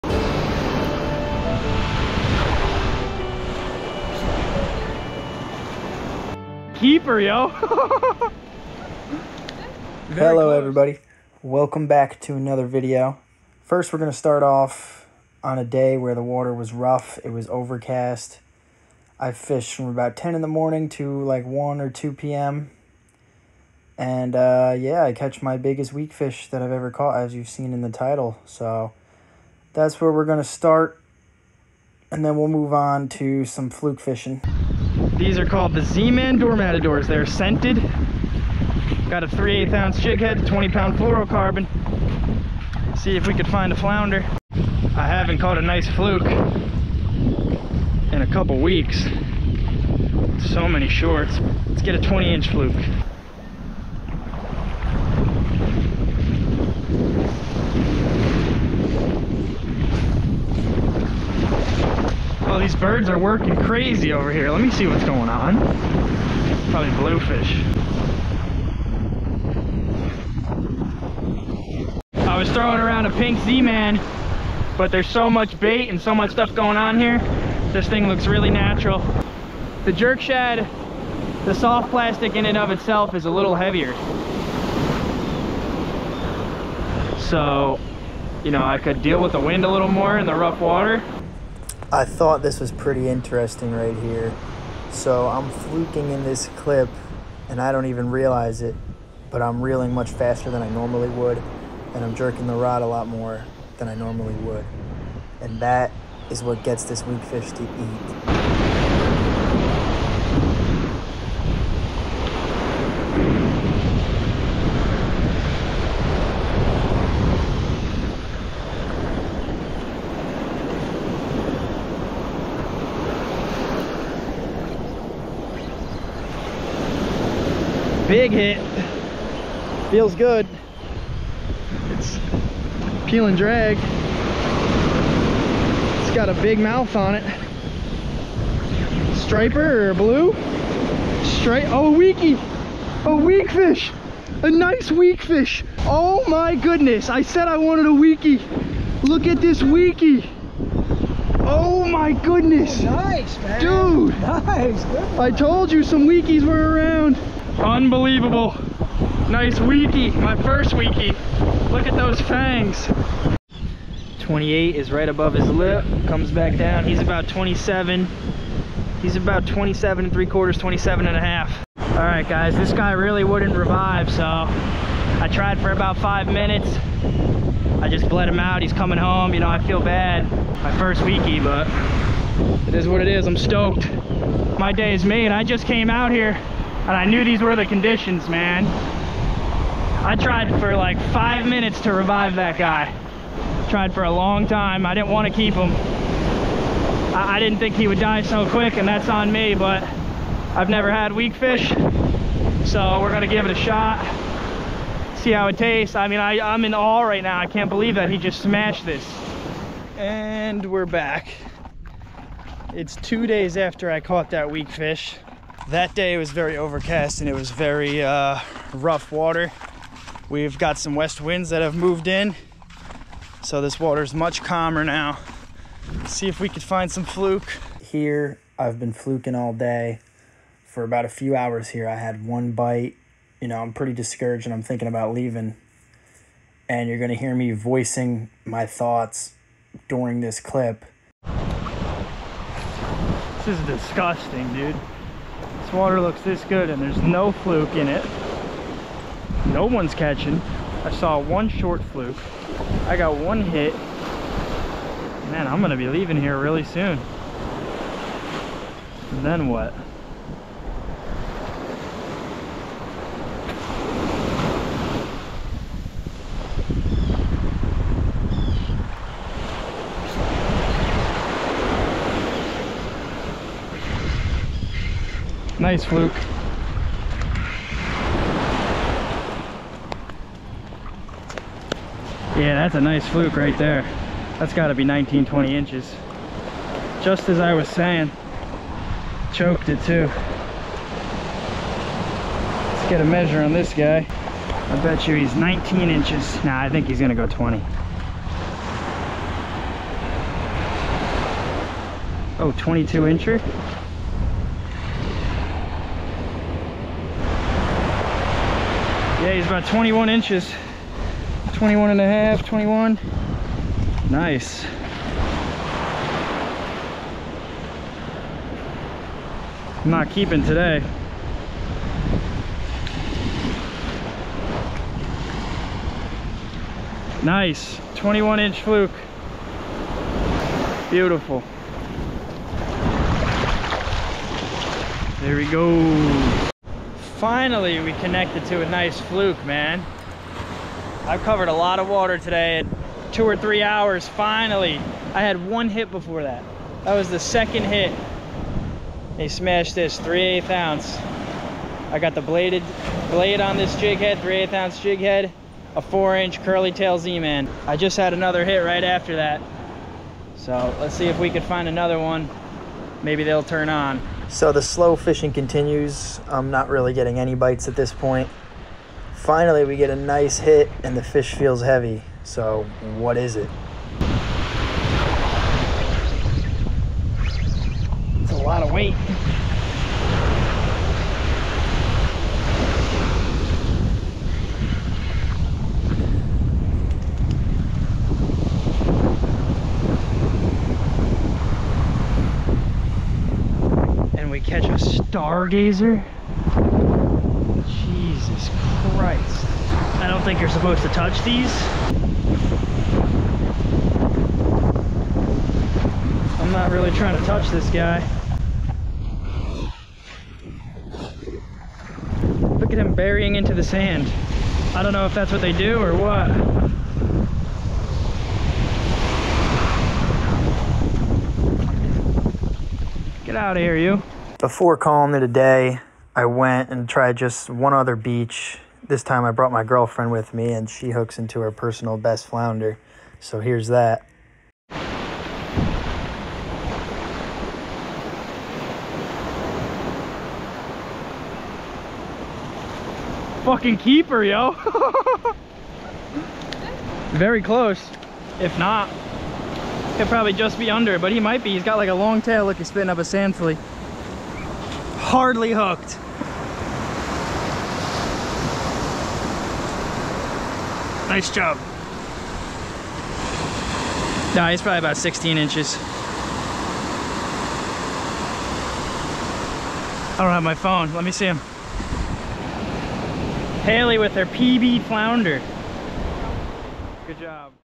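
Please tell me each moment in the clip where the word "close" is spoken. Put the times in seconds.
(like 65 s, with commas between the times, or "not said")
10 s, 447 s.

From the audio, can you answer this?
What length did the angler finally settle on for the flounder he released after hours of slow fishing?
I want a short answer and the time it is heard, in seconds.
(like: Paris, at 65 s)
21 inches, at 327 s.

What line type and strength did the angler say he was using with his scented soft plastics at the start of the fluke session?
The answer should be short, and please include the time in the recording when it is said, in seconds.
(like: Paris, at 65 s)
20 pound fluorocarbon, at 40 s.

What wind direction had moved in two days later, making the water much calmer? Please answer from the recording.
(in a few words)
west.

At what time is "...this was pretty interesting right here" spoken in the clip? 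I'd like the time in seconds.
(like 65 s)
92 s.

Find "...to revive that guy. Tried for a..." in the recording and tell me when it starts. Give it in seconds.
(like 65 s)
191 s.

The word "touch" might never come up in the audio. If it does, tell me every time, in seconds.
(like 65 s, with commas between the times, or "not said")
400 s, 407 s.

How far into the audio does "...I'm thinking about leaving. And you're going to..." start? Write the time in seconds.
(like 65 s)
234 s.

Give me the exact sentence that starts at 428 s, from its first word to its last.
This time I brought my girlfriend with me and she hooks into her personal best flounder.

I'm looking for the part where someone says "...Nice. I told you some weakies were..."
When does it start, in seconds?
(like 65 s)
154 s.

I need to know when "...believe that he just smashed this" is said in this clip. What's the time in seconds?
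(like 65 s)
207 s.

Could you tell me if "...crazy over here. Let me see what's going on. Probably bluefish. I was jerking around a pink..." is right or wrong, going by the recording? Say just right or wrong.
wrong.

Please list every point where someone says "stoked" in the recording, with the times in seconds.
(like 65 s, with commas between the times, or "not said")
183 s.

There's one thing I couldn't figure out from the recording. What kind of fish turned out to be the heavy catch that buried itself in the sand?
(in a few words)
stargazer.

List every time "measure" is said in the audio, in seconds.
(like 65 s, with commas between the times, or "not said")
293 s.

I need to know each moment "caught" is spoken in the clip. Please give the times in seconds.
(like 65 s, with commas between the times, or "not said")
26 s, 45 s, 213 s.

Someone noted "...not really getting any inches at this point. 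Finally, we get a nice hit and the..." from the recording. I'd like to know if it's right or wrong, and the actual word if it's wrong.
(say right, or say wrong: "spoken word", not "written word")
wrong: "bites", not "inches".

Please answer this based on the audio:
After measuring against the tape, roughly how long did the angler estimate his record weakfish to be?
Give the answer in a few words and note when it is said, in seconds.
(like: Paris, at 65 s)
27 and a half inches, at 170 s.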